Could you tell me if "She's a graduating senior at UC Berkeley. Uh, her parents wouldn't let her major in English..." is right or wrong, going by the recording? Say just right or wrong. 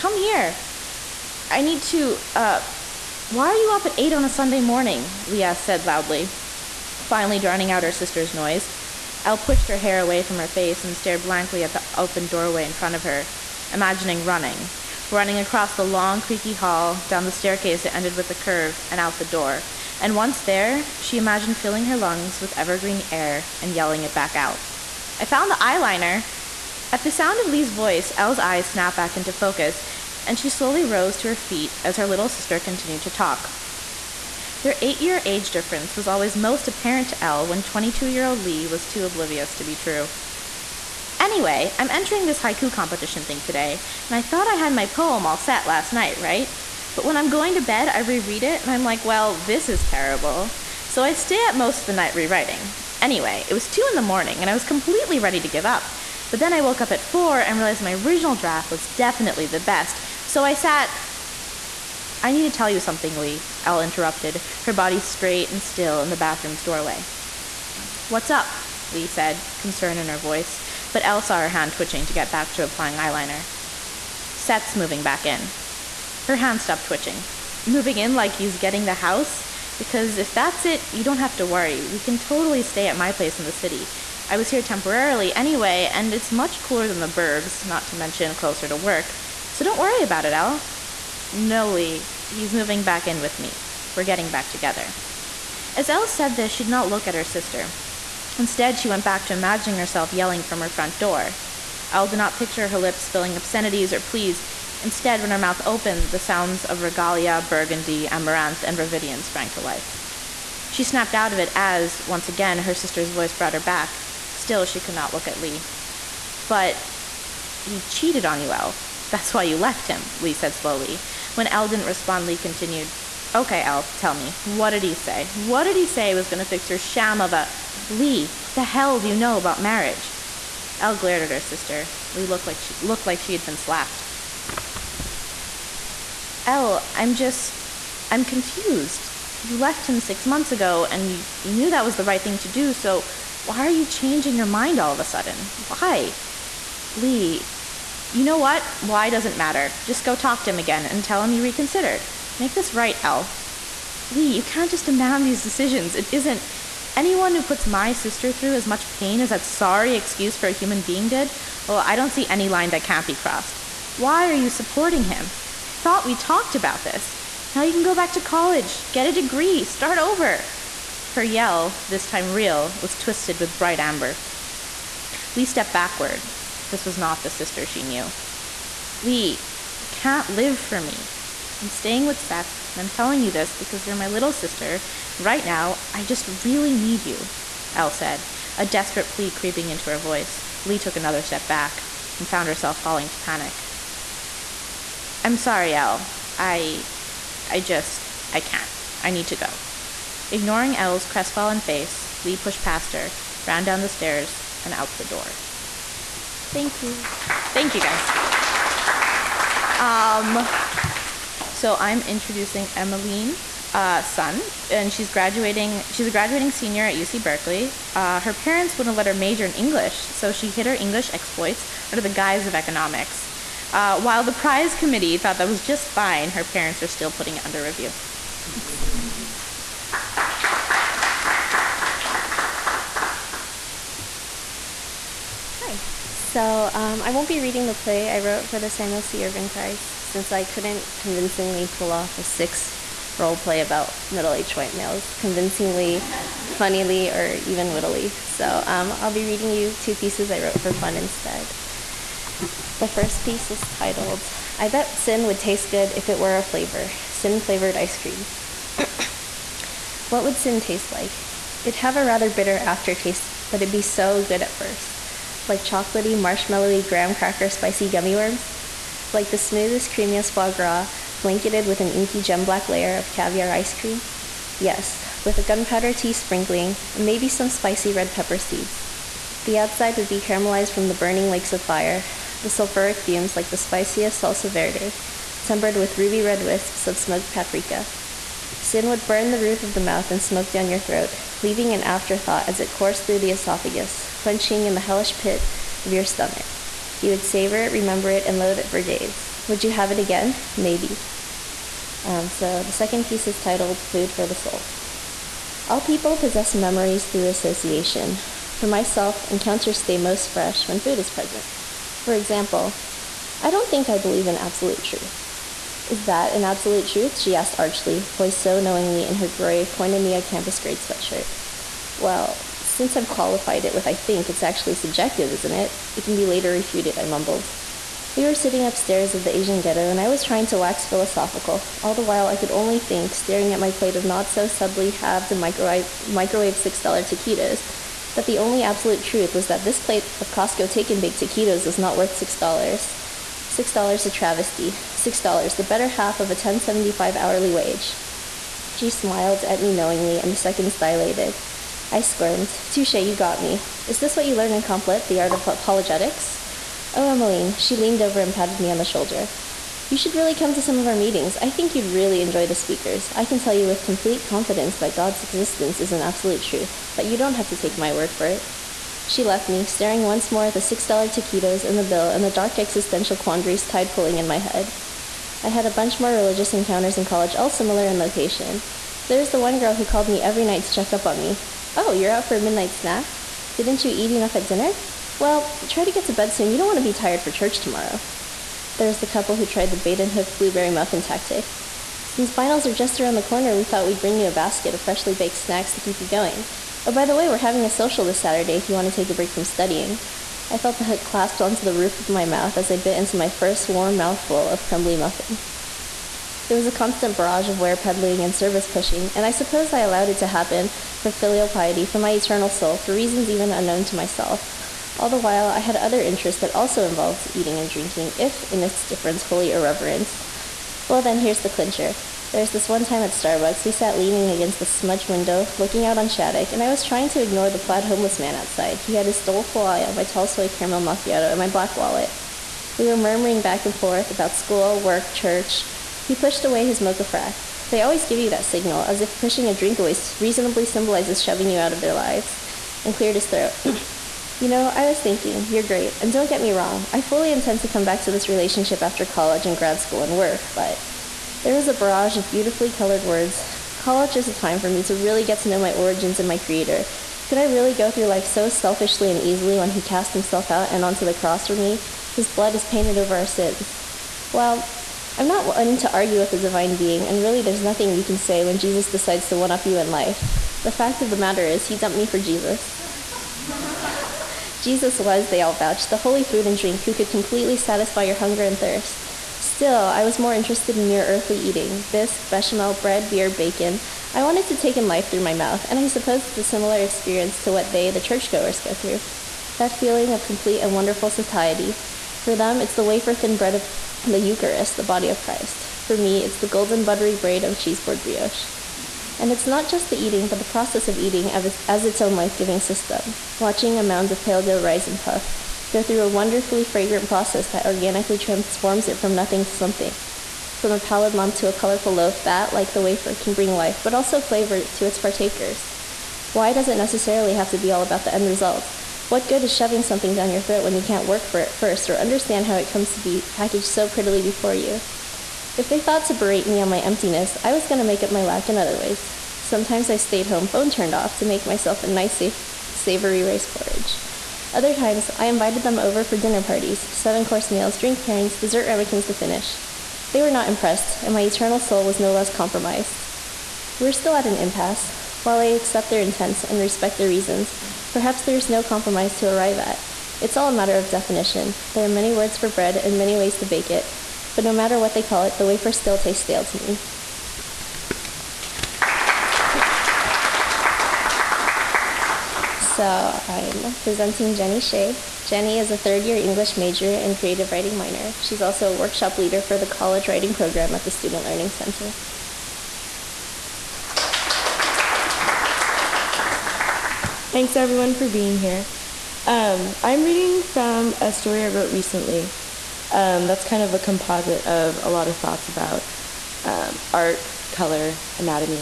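right.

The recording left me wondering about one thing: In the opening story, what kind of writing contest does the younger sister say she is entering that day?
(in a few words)
haiku competition.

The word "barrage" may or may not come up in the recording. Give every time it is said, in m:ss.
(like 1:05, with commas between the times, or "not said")
6:47, 7:31.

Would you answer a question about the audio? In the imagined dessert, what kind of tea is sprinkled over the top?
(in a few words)
gunpowder tea.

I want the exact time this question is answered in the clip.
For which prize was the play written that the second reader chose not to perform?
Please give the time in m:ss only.
3:58.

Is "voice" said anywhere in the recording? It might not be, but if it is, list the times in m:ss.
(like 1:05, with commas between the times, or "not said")
0:27, 1:10, 1:53, 3:09.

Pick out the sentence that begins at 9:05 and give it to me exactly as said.
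While I accept their intents and respect their reasons, perhaps there is no compromise to arrive at.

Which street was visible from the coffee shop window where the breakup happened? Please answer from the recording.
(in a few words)
Shattuck.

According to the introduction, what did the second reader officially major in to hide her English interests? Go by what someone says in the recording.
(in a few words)
economics.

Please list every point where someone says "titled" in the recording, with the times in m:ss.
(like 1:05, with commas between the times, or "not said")
4:13, 5:03.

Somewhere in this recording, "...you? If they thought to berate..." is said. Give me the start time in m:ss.
8:44.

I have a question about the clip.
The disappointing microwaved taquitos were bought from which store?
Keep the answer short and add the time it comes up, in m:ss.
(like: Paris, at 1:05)
Costco, at 5:40.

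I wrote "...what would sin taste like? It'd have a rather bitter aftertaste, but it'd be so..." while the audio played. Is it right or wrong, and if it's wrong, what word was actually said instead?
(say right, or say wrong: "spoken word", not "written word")
right.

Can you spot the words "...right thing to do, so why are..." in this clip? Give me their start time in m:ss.
2:22.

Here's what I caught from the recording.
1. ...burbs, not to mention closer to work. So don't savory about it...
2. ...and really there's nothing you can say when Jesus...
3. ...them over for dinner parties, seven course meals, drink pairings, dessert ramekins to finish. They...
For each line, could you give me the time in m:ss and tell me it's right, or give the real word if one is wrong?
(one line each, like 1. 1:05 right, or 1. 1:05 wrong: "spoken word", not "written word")
1. 1:27 wrong: "worry", not "savory"
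2. 7:47 right
3. 8:55 right.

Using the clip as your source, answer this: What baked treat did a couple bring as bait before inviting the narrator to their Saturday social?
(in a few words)
blueberry muffin.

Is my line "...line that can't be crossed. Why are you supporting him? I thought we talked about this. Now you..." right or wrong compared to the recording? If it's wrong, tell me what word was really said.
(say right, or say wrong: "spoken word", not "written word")
right.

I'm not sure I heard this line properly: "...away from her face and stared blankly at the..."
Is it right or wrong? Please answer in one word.
right.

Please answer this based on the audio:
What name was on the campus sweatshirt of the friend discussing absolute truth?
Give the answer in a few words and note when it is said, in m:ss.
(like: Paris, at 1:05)
Koinonia, at 5:19.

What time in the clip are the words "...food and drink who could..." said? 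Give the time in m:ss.
7:56.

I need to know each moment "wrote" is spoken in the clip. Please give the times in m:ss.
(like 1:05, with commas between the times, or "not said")
3:58, 4:10, 9:41.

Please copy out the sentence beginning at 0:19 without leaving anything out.
And once there, she imagined filling her lungs with evergreen air and yelling it back out.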